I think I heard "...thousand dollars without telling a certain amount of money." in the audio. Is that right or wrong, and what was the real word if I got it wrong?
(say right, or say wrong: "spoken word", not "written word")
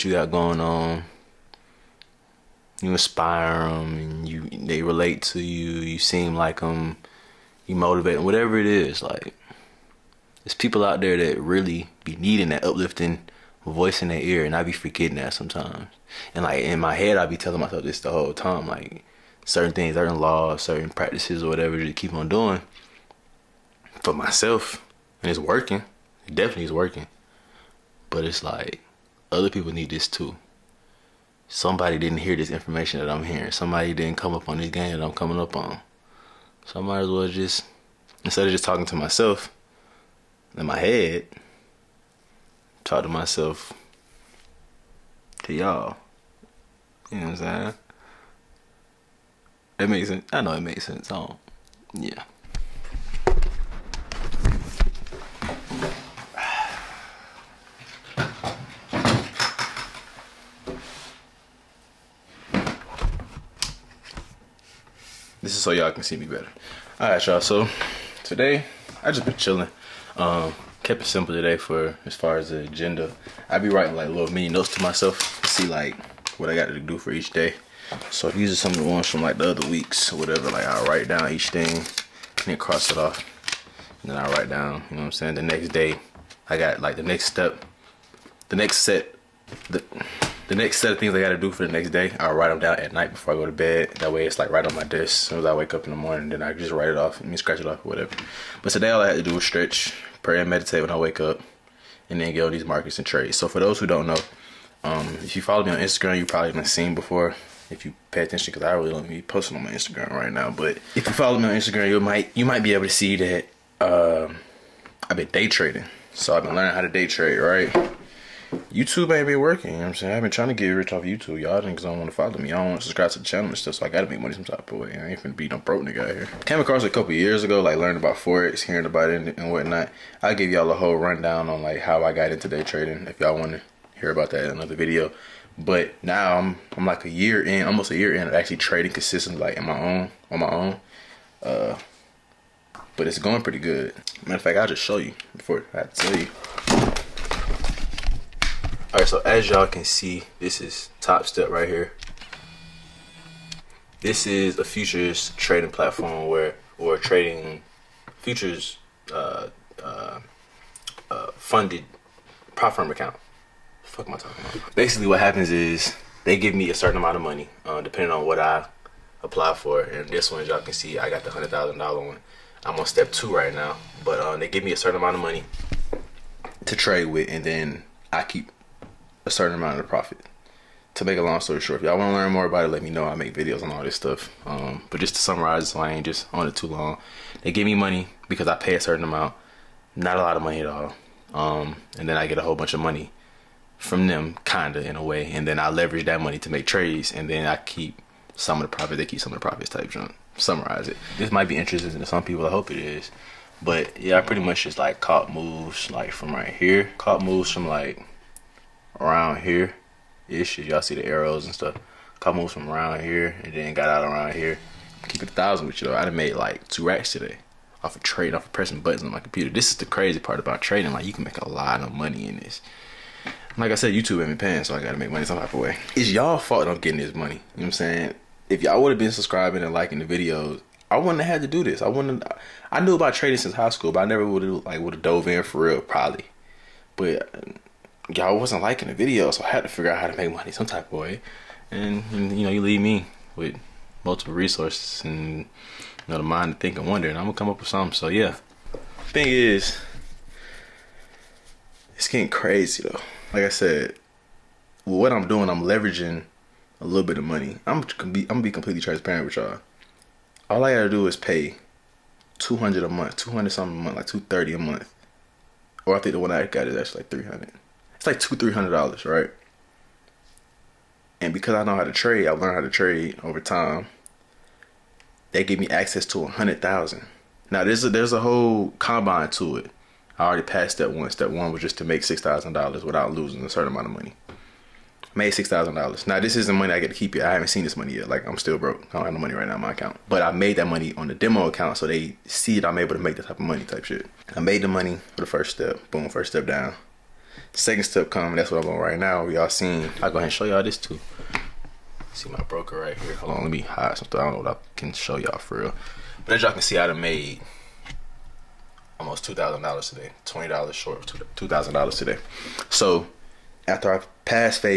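wrong: "losing", not "telling".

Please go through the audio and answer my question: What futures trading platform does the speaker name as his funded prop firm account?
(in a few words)
Topstep.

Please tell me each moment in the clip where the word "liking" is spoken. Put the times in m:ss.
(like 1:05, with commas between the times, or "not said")
3:49, 3:58.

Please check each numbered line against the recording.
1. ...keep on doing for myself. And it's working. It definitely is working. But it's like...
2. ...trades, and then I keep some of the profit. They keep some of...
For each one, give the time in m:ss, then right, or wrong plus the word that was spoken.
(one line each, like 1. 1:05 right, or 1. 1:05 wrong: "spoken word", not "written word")
1. 0:21 right
2. 3:16 right.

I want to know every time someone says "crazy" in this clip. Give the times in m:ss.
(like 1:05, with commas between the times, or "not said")
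3:39, 4:12.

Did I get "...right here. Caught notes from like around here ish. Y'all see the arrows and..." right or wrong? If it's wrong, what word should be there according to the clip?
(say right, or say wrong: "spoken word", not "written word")
wrong: "moves", not "notes".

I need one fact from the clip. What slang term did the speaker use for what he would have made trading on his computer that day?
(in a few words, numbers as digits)
two racks.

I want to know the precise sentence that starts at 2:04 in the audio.
I ain't finna be no broke nigga out here.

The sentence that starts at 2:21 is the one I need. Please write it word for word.
Uh, but it's going pretty good.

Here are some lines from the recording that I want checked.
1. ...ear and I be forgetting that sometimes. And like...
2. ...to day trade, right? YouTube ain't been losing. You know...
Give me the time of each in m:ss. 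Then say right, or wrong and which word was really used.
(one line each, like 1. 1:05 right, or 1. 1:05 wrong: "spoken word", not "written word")
1. 0:14 right
2. 1:56 wrong: "working", not "losing".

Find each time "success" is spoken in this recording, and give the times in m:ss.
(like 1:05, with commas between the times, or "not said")
not said.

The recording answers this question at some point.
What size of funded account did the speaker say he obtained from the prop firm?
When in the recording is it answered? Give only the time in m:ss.
2:51.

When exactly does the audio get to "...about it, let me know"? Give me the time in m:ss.
3:02.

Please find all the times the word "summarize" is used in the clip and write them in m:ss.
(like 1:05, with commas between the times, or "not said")
3:05, 3:20.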